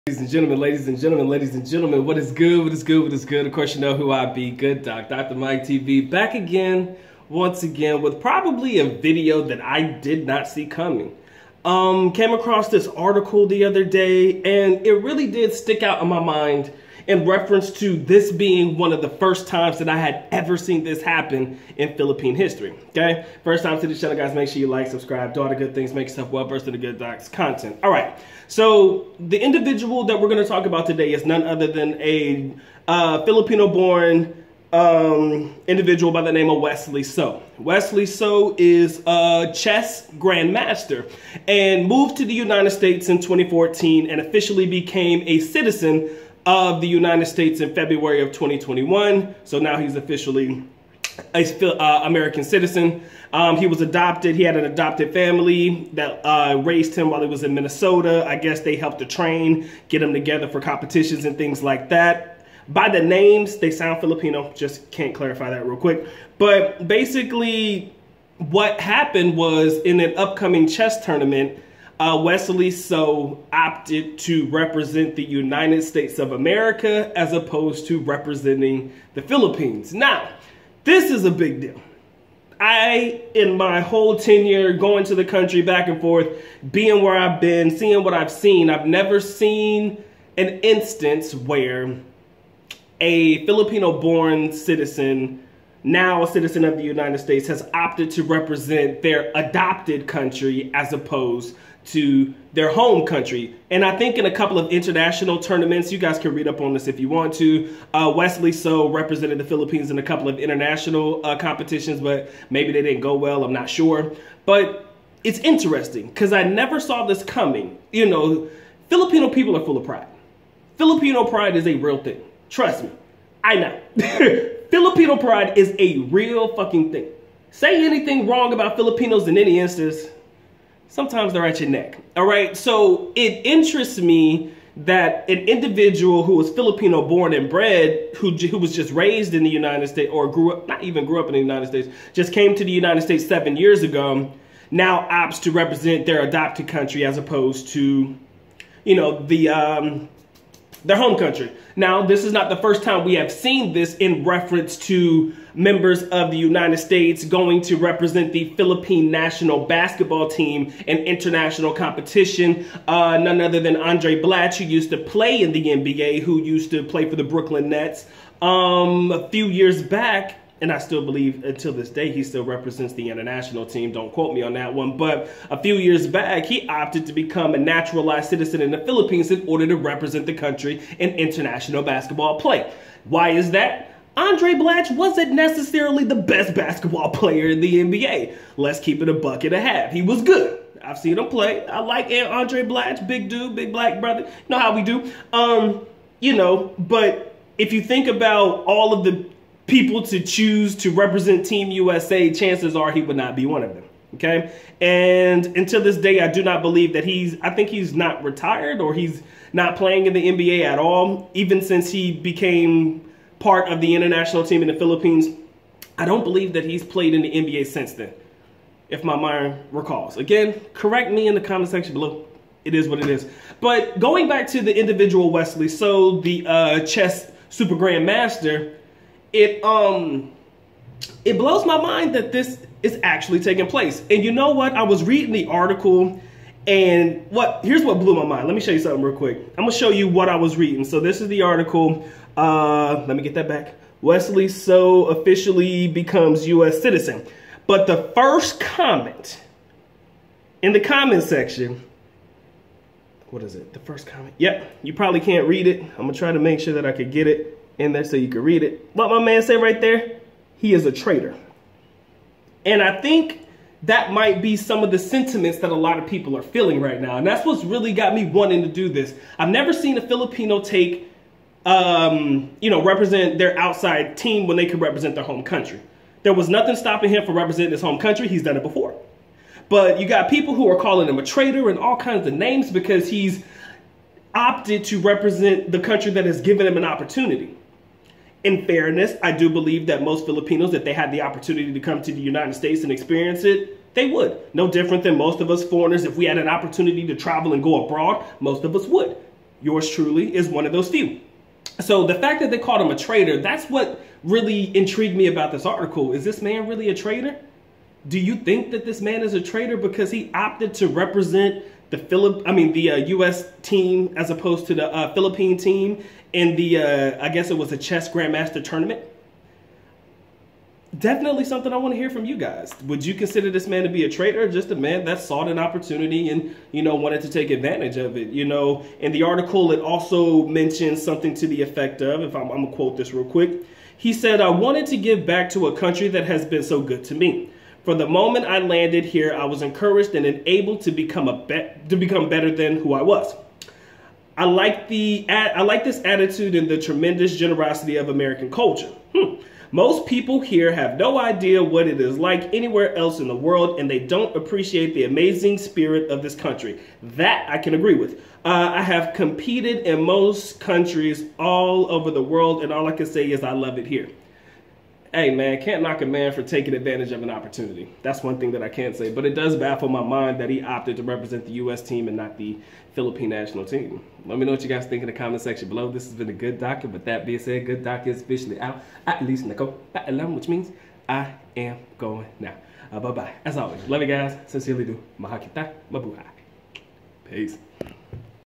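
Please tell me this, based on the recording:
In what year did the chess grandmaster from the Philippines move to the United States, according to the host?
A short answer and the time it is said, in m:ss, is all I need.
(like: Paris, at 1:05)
2014, at 0:43.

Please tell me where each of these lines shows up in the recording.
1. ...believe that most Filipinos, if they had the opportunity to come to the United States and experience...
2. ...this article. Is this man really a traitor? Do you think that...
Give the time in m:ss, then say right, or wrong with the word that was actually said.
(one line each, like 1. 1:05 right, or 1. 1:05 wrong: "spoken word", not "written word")
1. 4:49 right
2. 5:05 right.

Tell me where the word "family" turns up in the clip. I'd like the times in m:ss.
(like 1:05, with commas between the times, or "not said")
0:55.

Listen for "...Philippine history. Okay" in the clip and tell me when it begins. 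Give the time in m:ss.
0:21.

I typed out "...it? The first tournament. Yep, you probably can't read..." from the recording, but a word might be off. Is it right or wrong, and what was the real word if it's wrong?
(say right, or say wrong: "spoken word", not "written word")
wrong: "comment", not "tournament".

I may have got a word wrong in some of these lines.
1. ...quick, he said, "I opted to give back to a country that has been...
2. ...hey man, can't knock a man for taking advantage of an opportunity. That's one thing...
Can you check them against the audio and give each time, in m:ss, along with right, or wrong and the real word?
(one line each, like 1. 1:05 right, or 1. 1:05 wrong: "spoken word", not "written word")
1. 5:33 wrong: "wanted", not "opted"
2. 6:05 right.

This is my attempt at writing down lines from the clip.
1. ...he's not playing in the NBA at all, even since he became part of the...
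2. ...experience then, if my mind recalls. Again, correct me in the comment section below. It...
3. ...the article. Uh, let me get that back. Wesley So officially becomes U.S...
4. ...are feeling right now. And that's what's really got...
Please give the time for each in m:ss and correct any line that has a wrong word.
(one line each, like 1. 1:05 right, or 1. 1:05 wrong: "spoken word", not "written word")
1. 3:28 right
2. 3:37 wrong: "since", not "experience"
3. 4:01 right
4. 4:26 right.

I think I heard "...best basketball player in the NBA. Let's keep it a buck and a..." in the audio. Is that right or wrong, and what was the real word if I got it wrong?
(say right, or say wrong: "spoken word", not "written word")
right.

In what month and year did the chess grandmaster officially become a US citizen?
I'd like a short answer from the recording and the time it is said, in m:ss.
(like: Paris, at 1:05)
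February 2021, at 0:47.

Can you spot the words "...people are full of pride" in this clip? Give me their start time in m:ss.
1:59.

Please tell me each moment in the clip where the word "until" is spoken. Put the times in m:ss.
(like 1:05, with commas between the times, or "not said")
2:51, 3:25.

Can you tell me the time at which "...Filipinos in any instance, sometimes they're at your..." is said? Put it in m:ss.
2:08.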